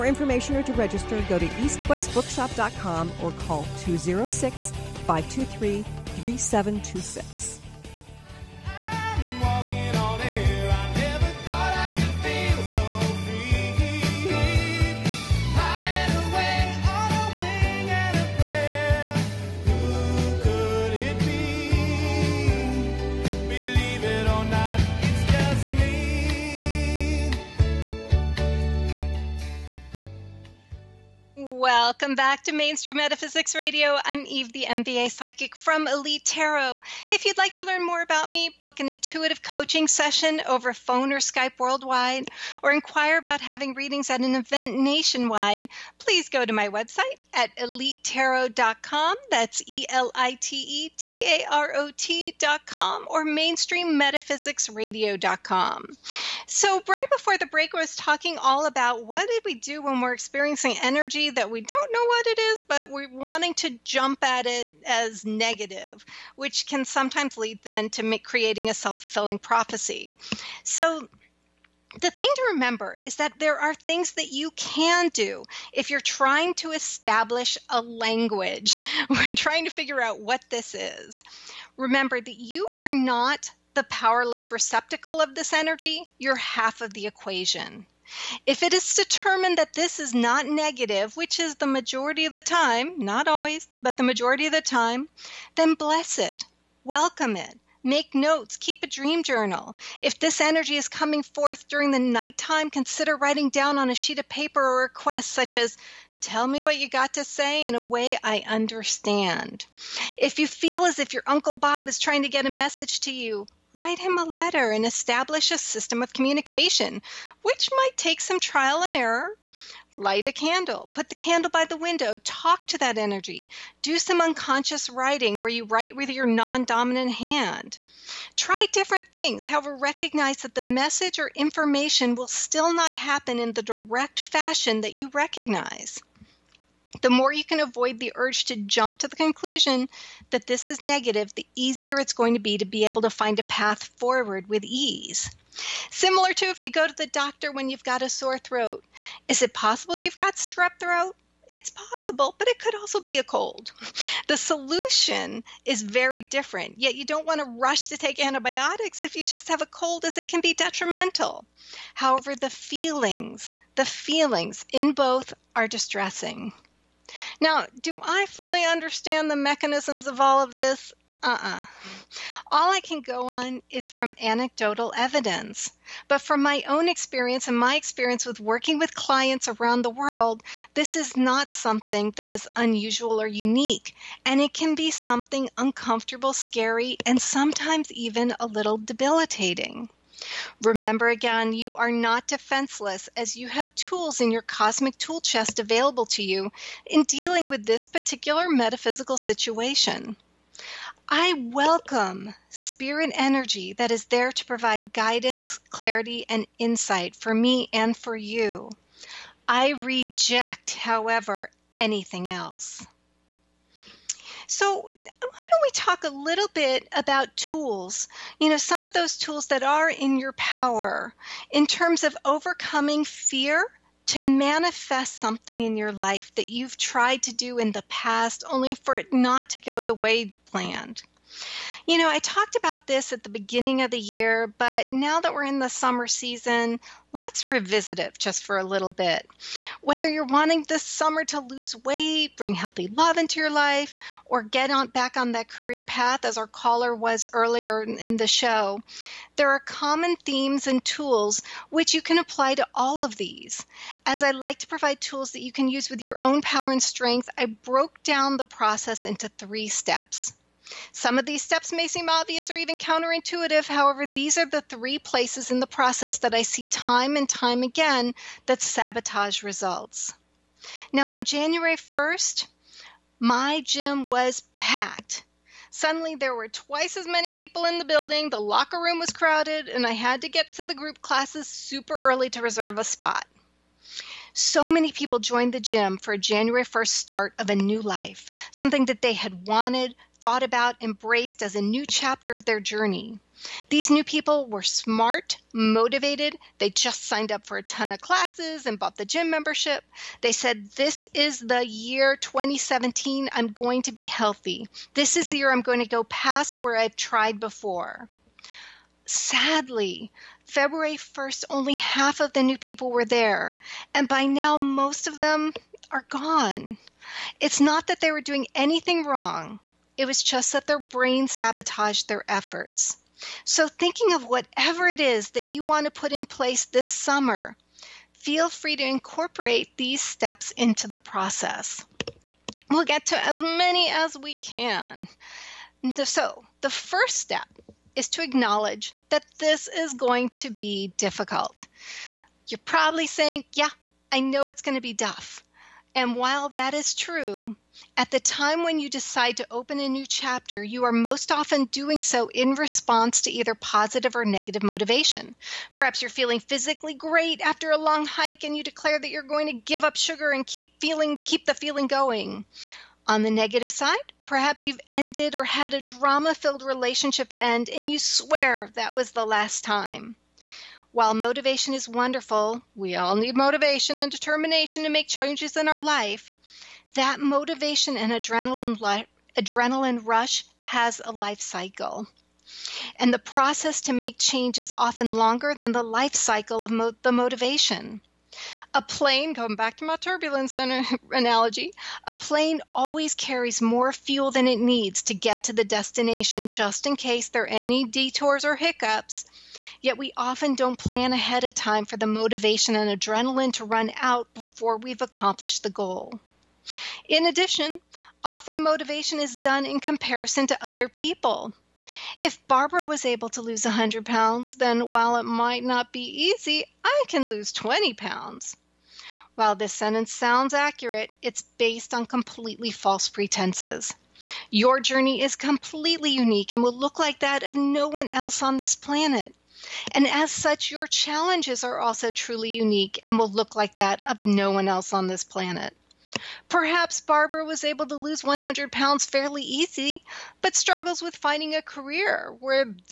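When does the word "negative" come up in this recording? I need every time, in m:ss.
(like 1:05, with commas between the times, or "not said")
1:05, 1:30, 2:20, 5:54, 6:03.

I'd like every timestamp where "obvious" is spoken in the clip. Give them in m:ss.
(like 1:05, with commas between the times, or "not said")
4:22.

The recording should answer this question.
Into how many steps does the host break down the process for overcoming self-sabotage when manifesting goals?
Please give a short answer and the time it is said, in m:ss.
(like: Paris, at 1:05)
3, at 4:19.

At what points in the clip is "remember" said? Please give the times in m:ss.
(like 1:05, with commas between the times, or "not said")
1:12, 1:21, 3:10.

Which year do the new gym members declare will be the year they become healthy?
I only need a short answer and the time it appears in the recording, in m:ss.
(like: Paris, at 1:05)
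2017, at 5:02.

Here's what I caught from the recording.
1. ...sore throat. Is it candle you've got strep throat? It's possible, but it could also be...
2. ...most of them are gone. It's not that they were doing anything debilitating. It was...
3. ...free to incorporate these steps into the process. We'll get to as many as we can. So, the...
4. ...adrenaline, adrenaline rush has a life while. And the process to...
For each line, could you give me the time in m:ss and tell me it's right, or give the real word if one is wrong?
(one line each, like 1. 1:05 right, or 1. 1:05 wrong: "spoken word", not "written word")
1. 2:28 wrong: "possible", not "candle"
2. 5:14 wrong: "wrong", not "debilitating"
3. 5:28 right
4. 6:18 wrong: "cycle", not "while".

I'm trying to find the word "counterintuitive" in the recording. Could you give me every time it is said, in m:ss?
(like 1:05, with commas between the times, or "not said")
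4:22.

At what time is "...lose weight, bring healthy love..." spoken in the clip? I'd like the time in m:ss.
4:01.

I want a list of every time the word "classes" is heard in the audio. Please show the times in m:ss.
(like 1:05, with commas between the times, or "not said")
4:41, 4:58.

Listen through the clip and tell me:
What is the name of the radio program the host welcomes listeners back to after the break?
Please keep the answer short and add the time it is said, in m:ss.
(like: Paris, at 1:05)
Mainstream Metaphysics Radio, at 0:32.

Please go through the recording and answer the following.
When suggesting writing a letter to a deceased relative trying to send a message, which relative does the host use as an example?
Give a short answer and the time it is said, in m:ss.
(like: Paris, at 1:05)
Uncle Bob, at 1:51.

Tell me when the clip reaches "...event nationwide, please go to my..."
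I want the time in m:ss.
0:44.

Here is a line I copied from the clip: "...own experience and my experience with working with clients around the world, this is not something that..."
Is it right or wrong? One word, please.
right.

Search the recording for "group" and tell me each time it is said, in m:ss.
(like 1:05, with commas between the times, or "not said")
4:40.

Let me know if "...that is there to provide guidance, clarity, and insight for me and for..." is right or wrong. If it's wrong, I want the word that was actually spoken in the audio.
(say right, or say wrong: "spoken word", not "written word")
right.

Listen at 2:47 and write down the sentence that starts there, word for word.
Now, do I fully understand the mechanisms of all of this?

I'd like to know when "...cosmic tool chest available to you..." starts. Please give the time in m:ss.
3:14.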